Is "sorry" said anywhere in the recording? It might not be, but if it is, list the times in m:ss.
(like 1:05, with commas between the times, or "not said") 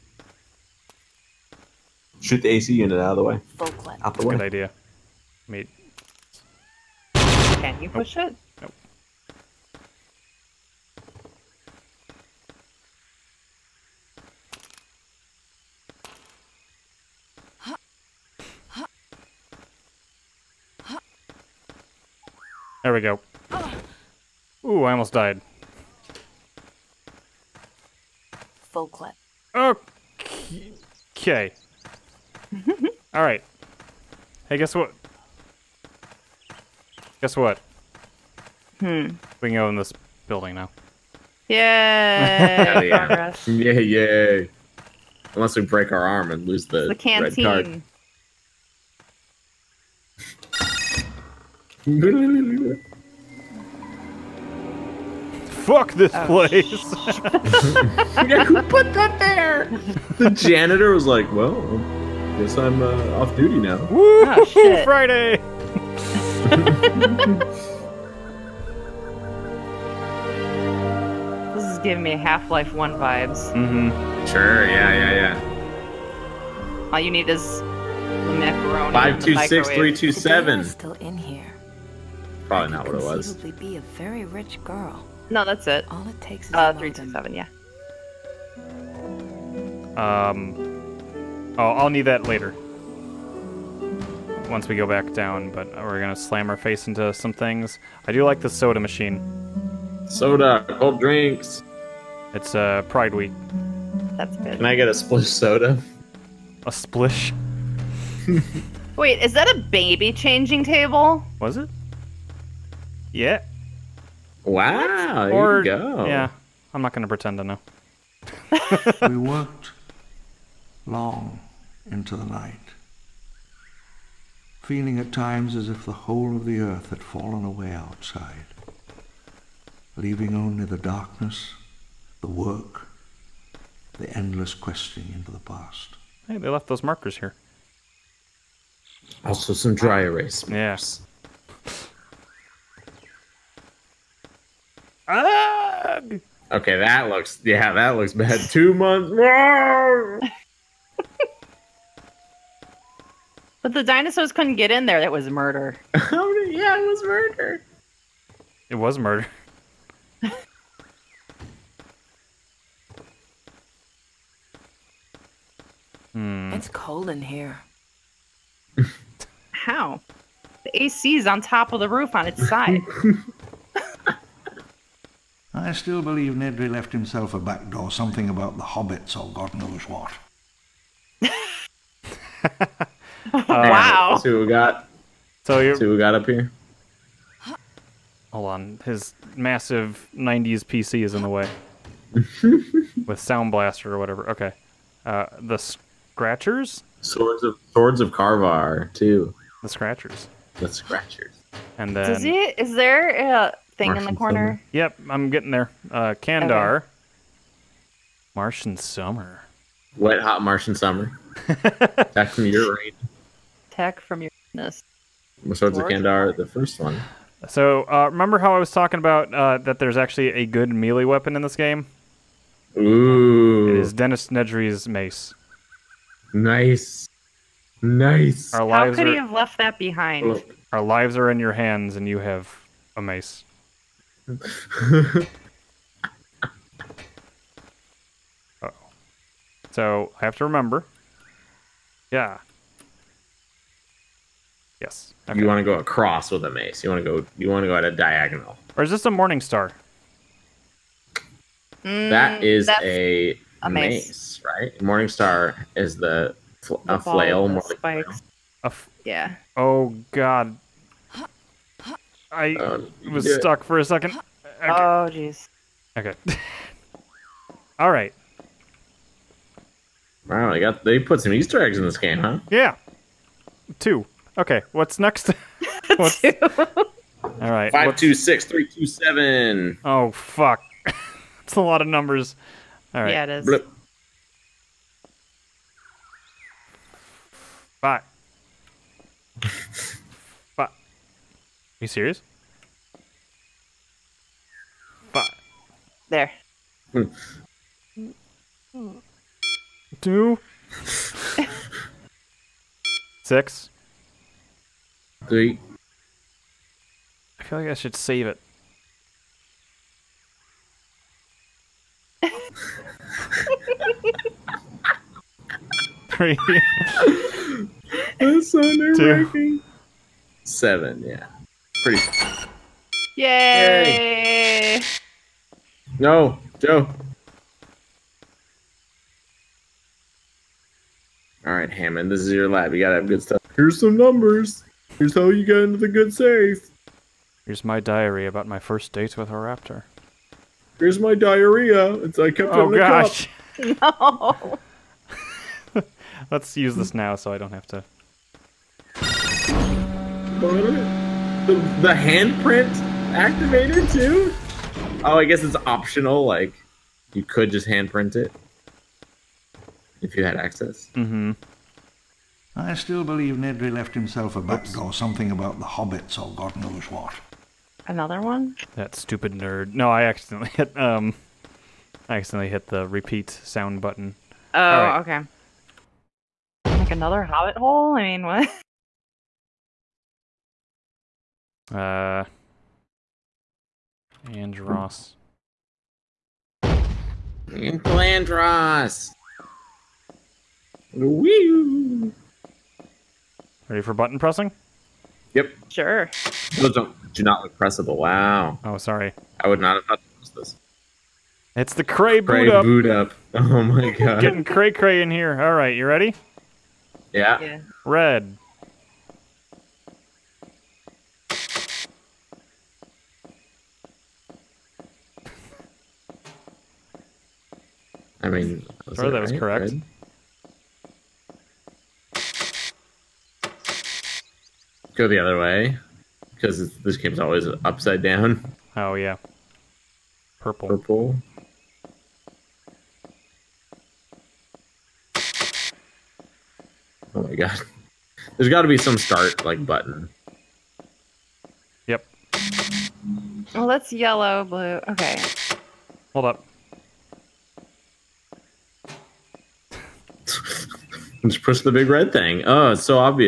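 6:38.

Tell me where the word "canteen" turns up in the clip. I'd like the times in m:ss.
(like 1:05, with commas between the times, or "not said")
0:46.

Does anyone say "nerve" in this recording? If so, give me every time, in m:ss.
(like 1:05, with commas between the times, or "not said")
5:18.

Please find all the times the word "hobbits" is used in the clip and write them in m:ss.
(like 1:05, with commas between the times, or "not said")
2:58, 6:05, 6:17.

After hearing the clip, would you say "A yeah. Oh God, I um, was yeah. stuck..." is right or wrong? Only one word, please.
right.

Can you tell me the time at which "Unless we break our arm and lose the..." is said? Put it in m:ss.
0:45.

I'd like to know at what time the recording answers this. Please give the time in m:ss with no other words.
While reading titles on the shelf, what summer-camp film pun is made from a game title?
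3:29.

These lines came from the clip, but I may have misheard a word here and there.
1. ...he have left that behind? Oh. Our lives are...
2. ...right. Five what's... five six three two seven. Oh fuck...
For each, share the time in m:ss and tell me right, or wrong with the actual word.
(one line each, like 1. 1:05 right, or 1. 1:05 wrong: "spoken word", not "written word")
1. 3:49 right
2. 4:37 wrong: "two", not "five".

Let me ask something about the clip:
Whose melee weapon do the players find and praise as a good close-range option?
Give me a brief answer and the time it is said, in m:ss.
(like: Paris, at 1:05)
Dennis Nedry, at 3:43.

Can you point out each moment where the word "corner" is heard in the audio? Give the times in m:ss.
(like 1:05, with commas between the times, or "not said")
3:24.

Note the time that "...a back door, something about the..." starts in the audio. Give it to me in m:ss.
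2:57.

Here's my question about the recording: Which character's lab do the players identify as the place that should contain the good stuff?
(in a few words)
Hammond.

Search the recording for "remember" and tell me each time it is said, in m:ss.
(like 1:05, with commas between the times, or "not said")
3:38, 4:00.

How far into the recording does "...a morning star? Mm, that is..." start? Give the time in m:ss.
4:09.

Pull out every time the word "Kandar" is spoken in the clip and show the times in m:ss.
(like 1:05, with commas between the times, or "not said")
3:26, 3:35.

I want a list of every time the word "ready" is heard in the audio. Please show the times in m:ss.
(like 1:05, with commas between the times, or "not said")
6:33, 6:45.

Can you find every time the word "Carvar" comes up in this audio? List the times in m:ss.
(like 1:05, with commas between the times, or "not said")
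3:18.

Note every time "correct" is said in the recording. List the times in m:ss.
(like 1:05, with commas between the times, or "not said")
6:59.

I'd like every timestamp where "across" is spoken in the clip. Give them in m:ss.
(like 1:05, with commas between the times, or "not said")
4:05.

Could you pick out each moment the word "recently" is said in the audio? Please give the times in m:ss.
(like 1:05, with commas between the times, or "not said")
not said.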